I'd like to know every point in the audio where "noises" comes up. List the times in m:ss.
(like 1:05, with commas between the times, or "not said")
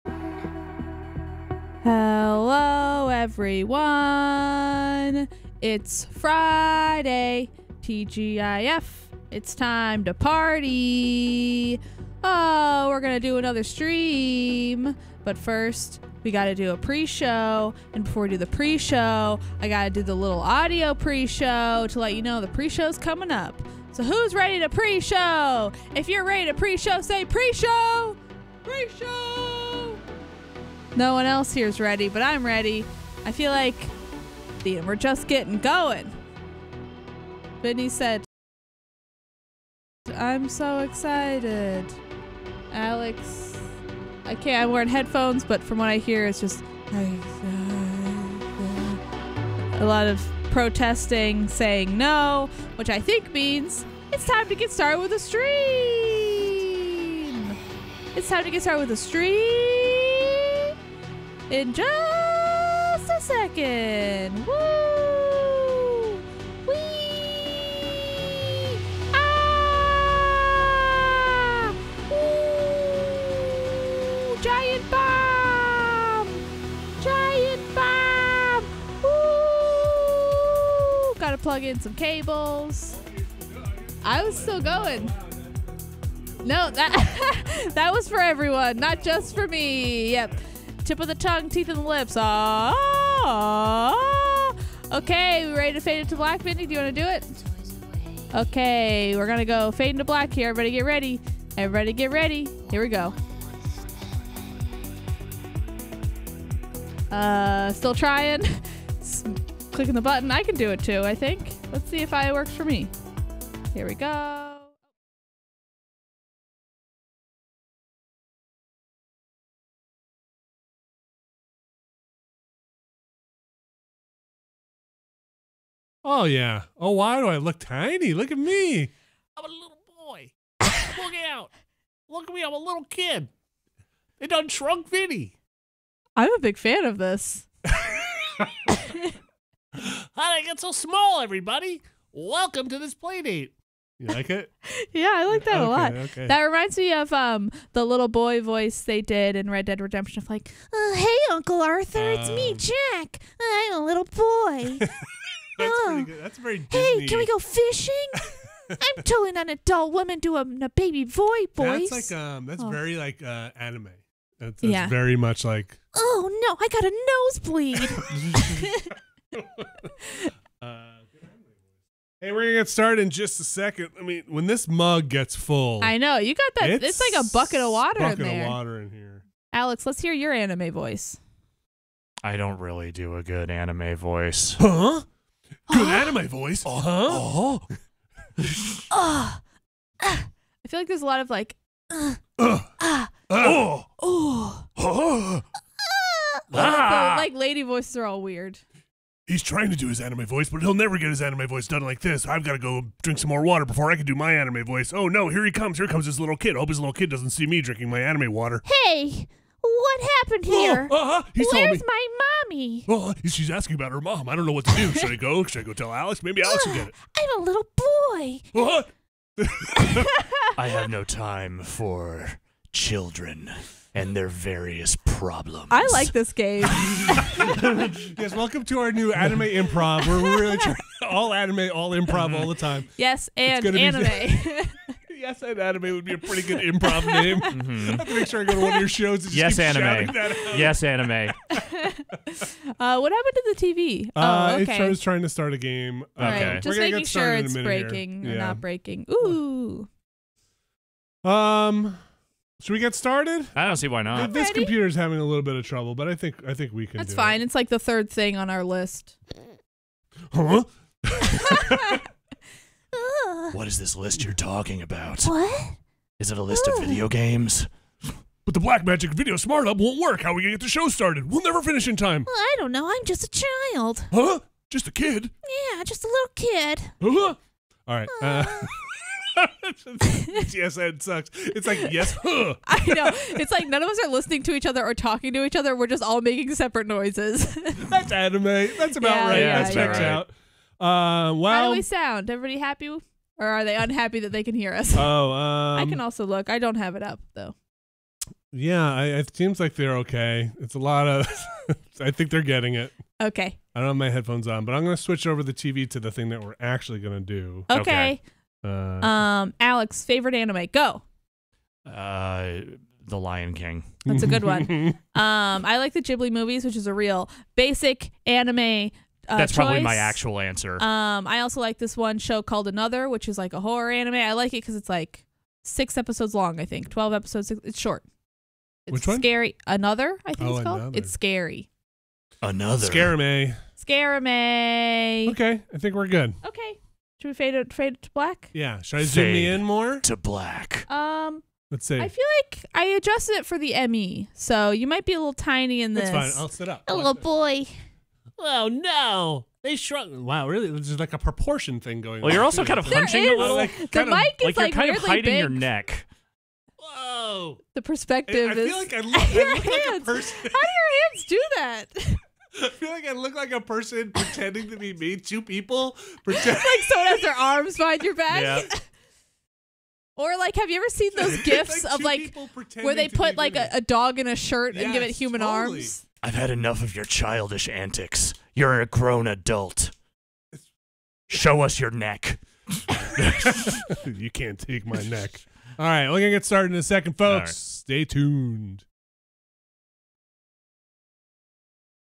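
4:46.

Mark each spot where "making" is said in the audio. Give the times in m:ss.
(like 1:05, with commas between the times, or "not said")
4:06, 4:46.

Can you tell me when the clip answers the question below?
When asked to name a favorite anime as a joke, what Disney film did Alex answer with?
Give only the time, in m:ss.
5:13.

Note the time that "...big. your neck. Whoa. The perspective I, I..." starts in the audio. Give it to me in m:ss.
5:55.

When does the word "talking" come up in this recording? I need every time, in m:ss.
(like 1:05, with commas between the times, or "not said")
4:24, 4:44.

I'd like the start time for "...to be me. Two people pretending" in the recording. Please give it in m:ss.
6:04.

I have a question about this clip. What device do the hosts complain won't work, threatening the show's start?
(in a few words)
Black Magic Video Smart Hub.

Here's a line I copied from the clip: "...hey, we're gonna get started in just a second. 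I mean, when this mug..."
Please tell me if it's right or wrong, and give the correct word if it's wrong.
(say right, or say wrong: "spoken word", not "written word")
right.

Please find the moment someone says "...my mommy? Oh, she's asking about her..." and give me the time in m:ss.
3:31.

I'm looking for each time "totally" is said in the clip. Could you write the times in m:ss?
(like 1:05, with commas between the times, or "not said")
2:39, 6:15.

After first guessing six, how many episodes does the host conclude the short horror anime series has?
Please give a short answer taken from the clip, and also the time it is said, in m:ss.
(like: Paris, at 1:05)
12, at 5:26.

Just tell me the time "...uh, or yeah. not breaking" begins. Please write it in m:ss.
4:08.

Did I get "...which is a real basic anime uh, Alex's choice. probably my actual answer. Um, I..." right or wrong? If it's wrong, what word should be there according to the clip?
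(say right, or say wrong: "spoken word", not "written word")
wrong: "That", not "Alex".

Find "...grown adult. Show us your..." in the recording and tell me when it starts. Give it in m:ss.
6:18.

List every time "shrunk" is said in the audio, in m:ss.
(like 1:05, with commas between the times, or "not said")
2:14, 5:49.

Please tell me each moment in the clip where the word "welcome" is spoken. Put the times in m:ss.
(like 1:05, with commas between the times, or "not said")
2:22, 3:48.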